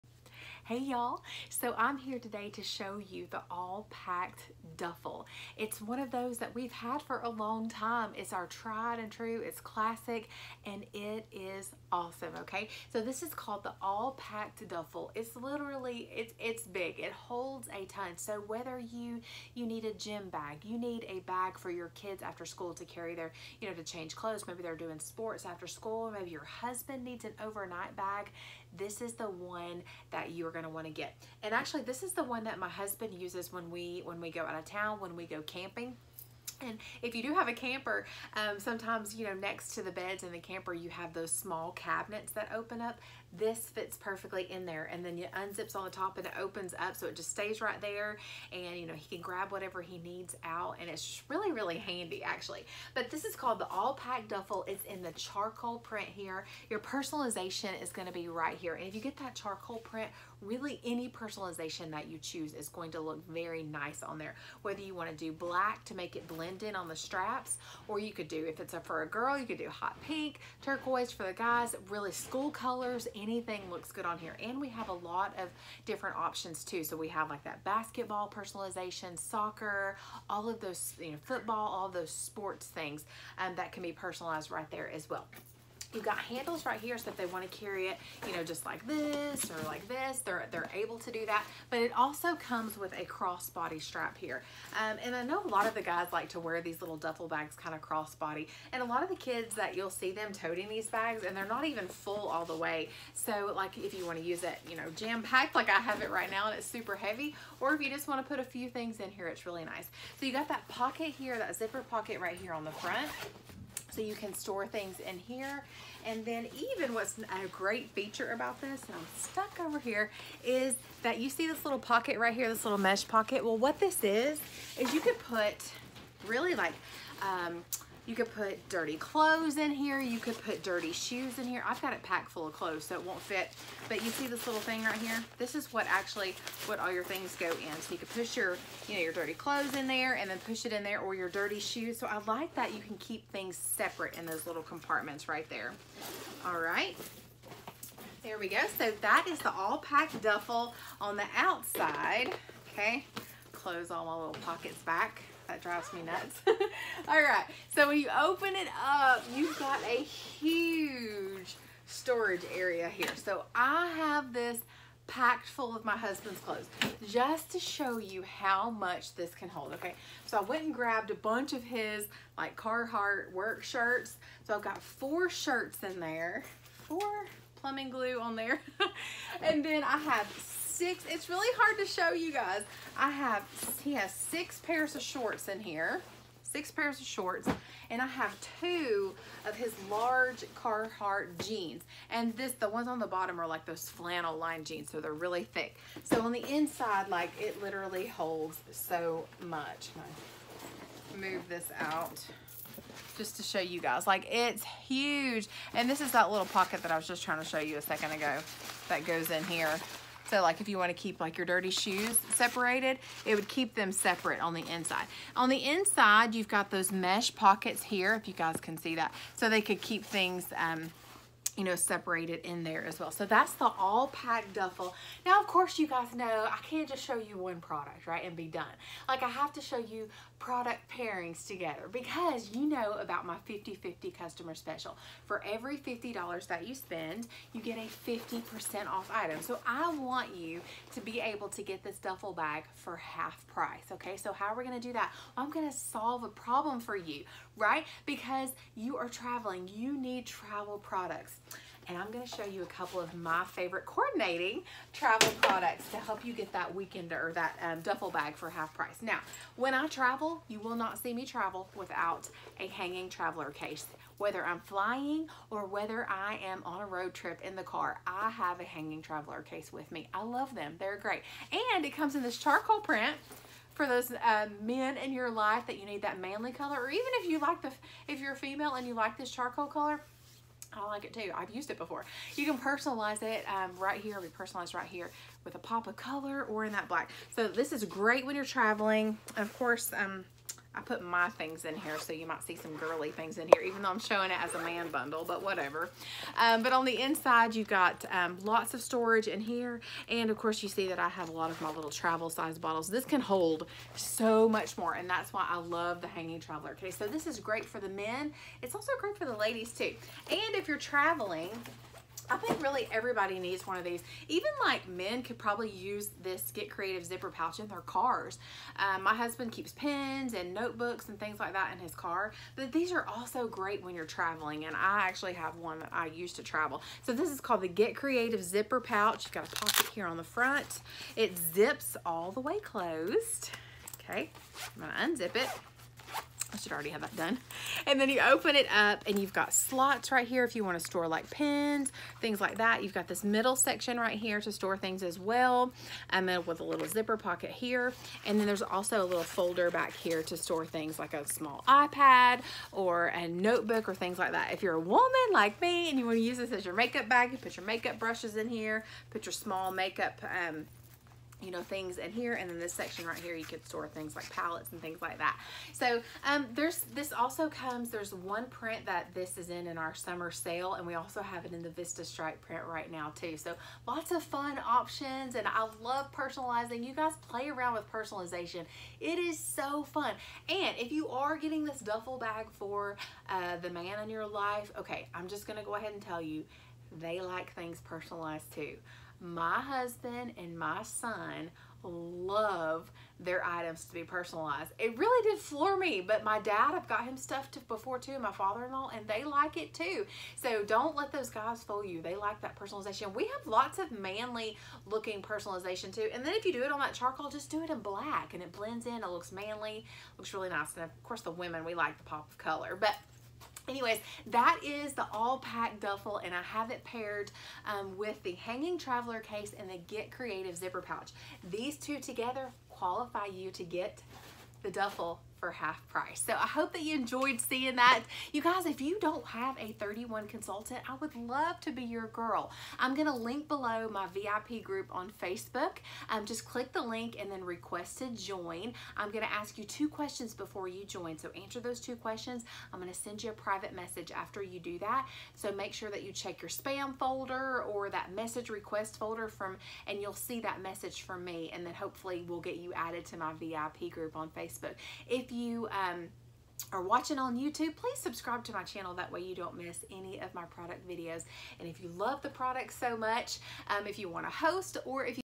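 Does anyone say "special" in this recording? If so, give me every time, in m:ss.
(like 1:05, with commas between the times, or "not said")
3:54.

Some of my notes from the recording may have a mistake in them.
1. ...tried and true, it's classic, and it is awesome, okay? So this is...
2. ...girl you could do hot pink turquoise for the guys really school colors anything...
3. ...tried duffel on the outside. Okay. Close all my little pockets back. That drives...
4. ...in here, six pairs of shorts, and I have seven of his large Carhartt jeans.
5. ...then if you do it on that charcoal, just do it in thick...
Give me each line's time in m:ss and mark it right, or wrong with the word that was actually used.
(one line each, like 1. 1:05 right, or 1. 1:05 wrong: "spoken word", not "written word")
1. 0:08 right
2. 1:09 right
3. 2:29 wrong: "packed", not "tried"
4. 3:05 wrong: "two", not "seven"
5. 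6:46 wrong: "black", not "thick".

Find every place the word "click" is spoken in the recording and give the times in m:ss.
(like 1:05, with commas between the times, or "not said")
7:16.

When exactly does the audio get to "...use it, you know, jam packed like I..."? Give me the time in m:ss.
1:44.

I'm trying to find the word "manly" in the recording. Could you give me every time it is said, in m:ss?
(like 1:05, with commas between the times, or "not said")
4:36, 6:43, 6:49.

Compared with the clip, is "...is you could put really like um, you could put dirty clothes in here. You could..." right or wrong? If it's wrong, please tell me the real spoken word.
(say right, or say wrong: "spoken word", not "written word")
right.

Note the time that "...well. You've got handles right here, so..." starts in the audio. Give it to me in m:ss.
1:25.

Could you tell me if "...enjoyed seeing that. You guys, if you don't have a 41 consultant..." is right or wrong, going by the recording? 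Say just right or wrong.
wrong.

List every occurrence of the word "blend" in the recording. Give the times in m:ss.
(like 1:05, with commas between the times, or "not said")
1:06, 6:48.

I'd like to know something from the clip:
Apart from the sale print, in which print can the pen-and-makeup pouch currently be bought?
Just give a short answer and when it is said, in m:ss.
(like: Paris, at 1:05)
Vista Stripe, at 6:11.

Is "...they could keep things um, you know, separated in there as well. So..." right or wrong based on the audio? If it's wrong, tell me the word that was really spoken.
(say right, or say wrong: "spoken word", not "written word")
right.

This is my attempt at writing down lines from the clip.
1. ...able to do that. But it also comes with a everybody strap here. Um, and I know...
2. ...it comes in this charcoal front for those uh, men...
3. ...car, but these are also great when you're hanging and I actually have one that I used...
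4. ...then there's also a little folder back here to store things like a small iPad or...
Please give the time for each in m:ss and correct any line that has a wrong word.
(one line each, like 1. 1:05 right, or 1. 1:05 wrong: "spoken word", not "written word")
1. 1:30 wrong: "crossbody", not "everybody"
2. 4:31 wrong: "print", not "front"
3. 5:21 wrong: "traveling", not "hanging"
4. 5:48 right.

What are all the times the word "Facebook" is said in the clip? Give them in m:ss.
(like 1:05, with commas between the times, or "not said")
7:15, 7:34.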